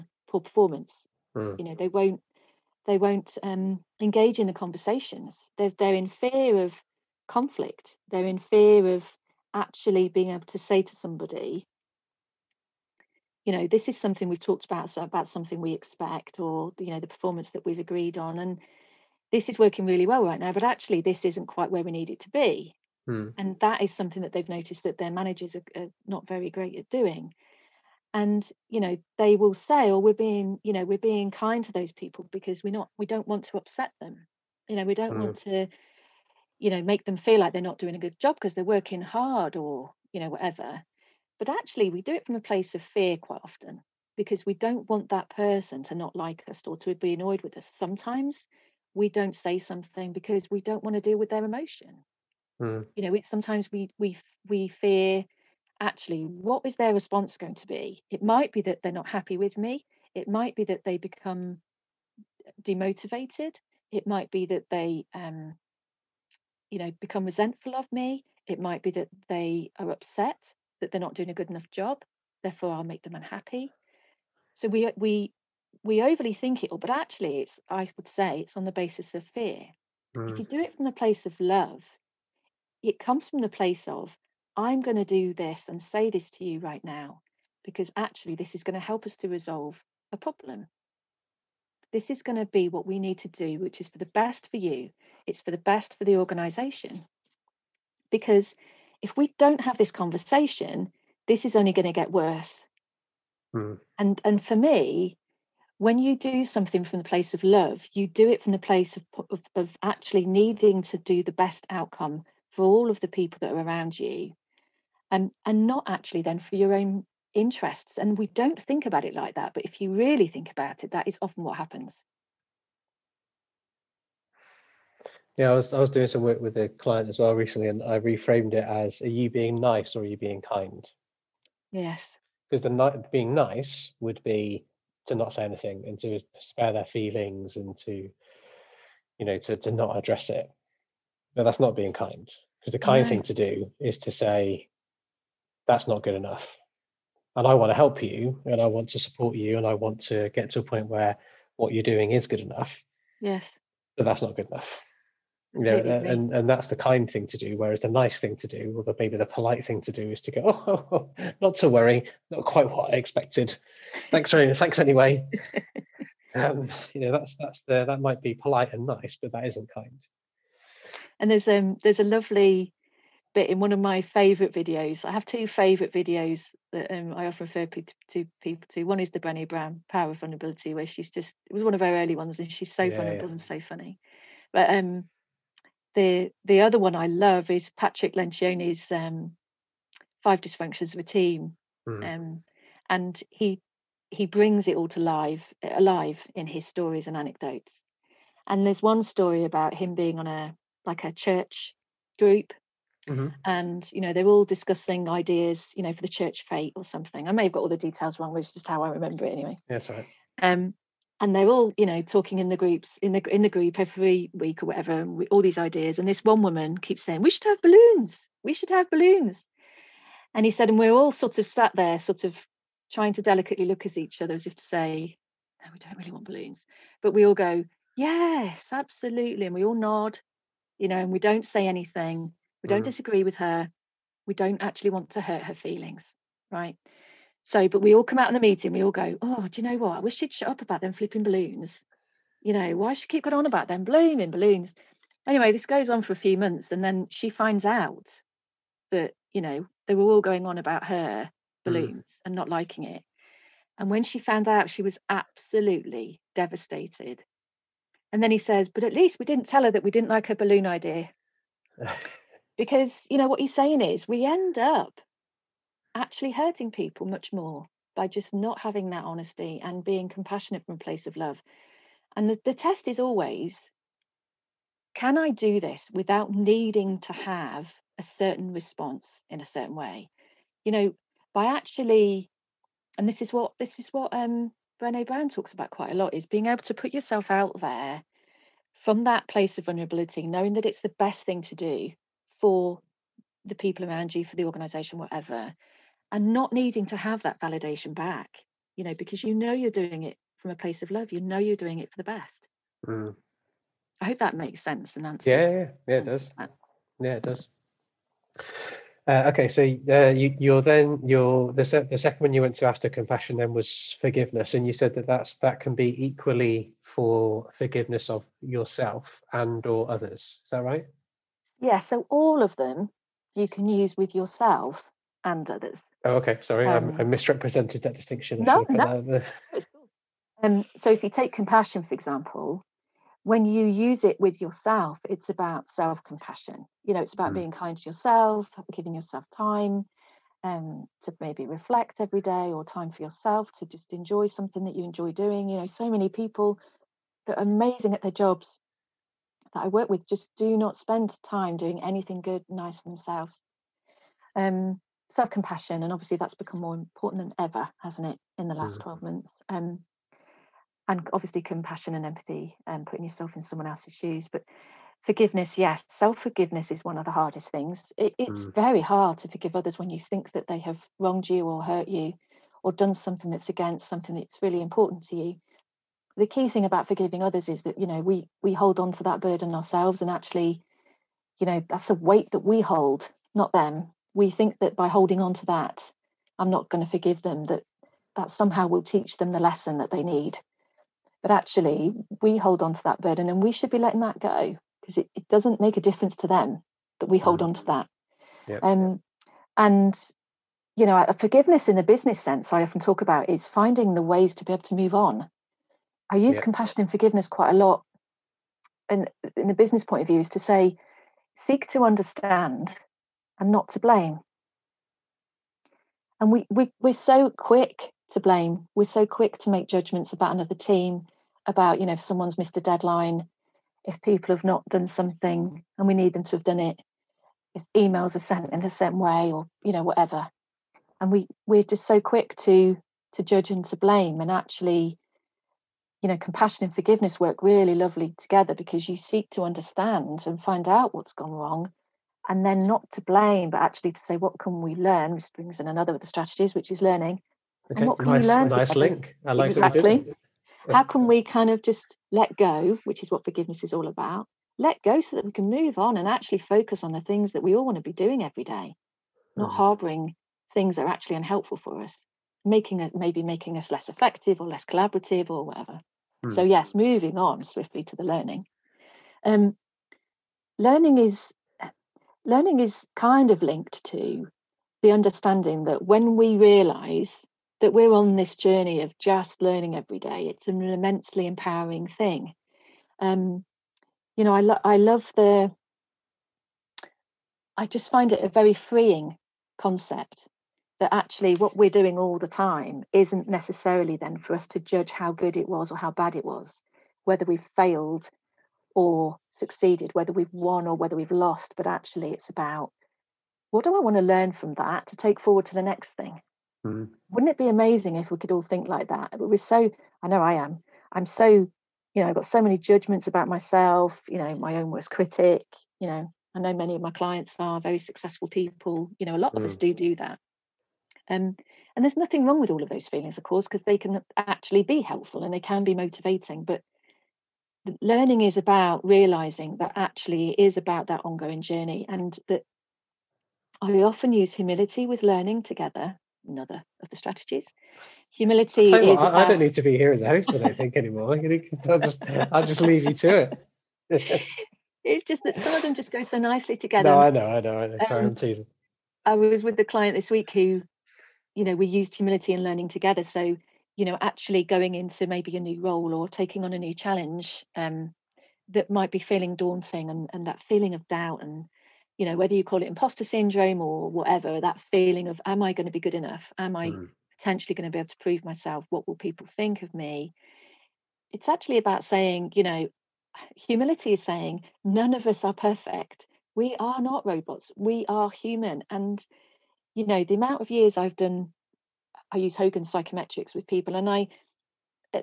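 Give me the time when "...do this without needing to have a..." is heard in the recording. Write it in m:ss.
4:35.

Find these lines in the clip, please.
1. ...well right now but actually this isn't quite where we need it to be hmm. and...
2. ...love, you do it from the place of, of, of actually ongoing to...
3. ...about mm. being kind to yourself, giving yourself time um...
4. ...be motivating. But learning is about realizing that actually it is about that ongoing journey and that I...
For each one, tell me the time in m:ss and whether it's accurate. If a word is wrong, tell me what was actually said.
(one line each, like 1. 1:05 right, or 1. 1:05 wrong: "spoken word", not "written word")
1. 0:20 right
2. 1:47 wrong: "needing", not "ongoing"
3. 5:37 right
4. 8:45 right.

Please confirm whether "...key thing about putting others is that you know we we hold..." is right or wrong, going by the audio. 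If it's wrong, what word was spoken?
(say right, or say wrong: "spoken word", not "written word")
wrong: "forgiving", not "putting".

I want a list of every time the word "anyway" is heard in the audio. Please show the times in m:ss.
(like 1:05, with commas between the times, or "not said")
2:44, 3:29, 4:05.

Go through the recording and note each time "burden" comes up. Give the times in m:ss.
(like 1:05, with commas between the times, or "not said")
6:19, 6:33.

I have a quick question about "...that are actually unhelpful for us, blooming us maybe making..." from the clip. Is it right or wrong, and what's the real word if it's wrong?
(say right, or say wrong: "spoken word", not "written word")
wrong: "making", not "blooming".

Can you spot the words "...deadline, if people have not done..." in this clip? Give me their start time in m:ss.
7:02.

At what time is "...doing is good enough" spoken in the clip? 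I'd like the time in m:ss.
2:31.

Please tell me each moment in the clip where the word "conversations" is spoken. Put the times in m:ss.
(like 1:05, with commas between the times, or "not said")
0:04, 1:39.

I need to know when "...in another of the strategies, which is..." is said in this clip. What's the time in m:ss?
7:25.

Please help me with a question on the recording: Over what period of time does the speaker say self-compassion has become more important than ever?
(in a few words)
12 months.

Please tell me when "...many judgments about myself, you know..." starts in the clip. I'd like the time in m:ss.
8:32.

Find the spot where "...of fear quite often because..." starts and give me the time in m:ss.
0:42.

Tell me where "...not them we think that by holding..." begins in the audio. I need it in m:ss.
6:23.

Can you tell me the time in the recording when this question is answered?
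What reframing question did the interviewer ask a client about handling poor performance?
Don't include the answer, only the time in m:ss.
2:09.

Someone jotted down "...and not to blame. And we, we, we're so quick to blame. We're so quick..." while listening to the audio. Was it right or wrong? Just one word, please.
right.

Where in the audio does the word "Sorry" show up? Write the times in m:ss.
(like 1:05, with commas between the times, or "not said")
5:26, 9:07.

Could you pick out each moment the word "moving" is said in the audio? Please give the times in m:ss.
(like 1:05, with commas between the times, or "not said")
7:46.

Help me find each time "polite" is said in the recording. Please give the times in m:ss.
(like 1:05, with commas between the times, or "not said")
2:39, 2:48.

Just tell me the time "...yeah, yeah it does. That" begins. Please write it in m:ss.
5:05.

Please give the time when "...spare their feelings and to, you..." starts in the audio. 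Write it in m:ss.
2:16.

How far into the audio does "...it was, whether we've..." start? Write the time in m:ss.
8:16.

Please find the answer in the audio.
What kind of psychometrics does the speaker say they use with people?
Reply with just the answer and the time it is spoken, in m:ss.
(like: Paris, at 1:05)
Hogan, at 9:42.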